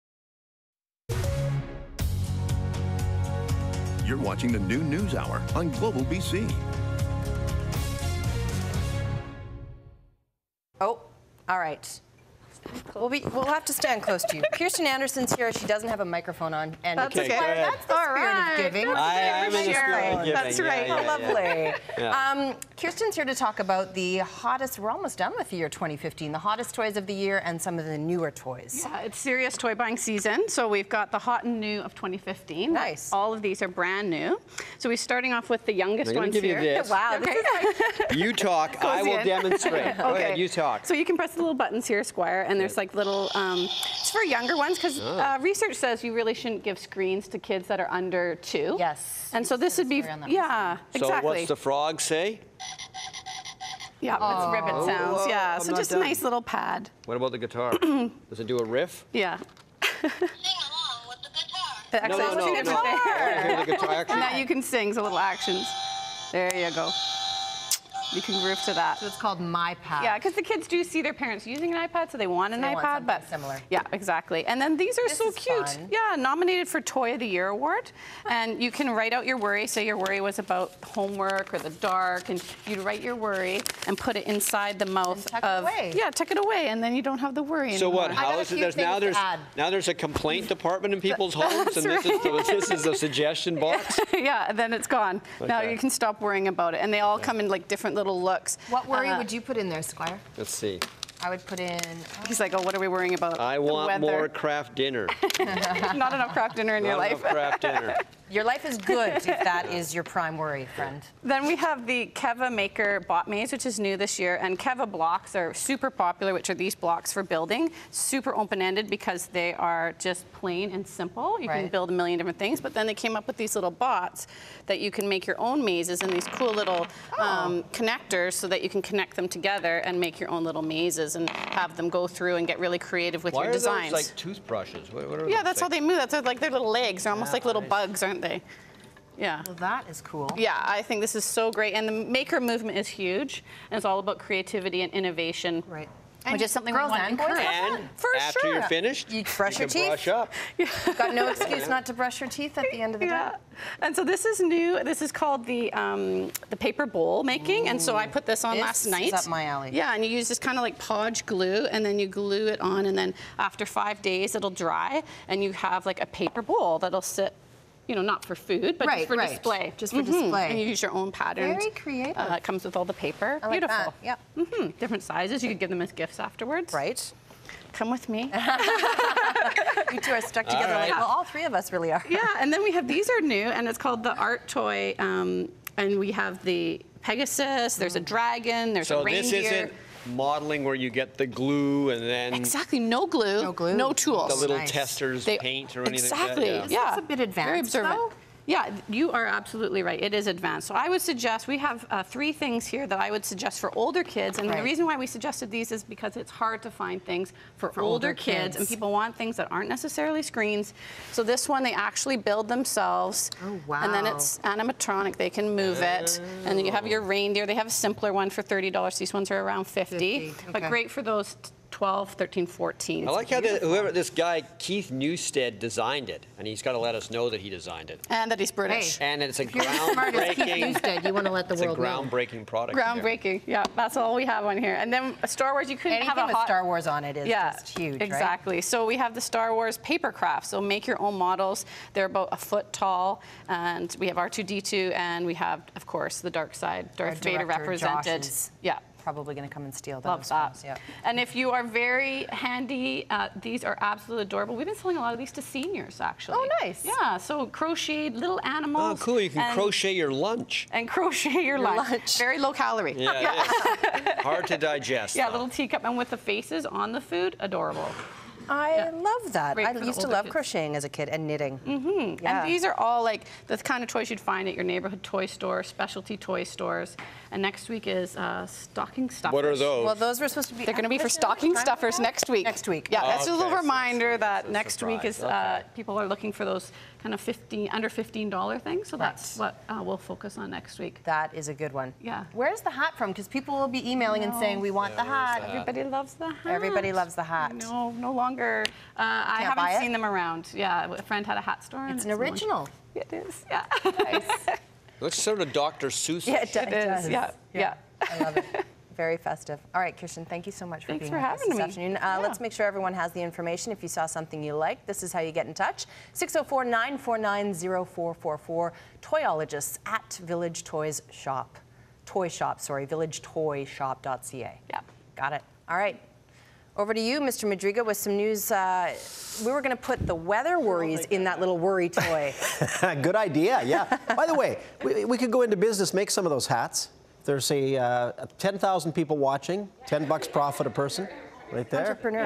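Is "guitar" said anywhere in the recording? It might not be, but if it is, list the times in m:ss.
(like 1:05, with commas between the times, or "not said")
0:57, 1:03.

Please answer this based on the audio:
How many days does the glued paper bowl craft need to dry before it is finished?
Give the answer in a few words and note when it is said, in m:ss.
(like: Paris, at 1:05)
5 days, at 2:43.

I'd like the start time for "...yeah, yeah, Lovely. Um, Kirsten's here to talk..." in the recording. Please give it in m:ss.
0:20.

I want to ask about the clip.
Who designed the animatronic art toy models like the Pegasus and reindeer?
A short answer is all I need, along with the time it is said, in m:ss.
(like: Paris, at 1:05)
Keith Newstead, at 3:44.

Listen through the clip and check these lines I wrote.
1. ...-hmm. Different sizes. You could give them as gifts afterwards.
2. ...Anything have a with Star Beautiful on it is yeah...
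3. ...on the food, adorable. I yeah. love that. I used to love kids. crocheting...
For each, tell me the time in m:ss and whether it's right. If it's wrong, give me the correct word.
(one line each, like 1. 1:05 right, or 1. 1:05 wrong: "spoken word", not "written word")
1. 2:54 right
2. 3:55 wrong: "Wars", not "Beautiful"
3. 4:26 right.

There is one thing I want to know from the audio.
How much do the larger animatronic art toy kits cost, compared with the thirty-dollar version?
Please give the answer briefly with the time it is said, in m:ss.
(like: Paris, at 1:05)
$50, at 3:39.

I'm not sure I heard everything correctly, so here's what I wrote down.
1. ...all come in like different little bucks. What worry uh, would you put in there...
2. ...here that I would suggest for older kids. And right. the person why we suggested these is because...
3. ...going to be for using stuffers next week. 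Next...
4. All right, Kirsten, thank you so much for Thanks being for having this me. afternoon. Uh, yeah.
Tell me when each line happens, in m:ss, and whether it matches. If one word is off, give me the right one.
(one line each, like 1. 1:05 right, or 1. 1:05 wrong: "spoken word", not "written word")
1. 1:36 wrong: "looks", not "bucks"
2. 3:22 wrong: "reason", not "person"
3. 4:40 wrong: "stocking", not "using"
4. 5:09 right.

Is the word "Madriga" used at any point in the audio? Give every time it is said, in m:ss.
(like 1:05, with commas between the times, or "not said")
5:27.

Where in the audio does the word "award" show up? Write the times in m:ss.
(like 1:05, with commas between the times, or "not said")
1:17.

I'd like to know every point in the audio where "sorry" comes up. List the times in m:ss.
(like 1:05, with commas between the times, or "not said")
5:22.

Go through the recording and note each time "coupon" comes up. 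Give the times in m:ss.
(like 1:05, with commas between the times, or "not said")
not said.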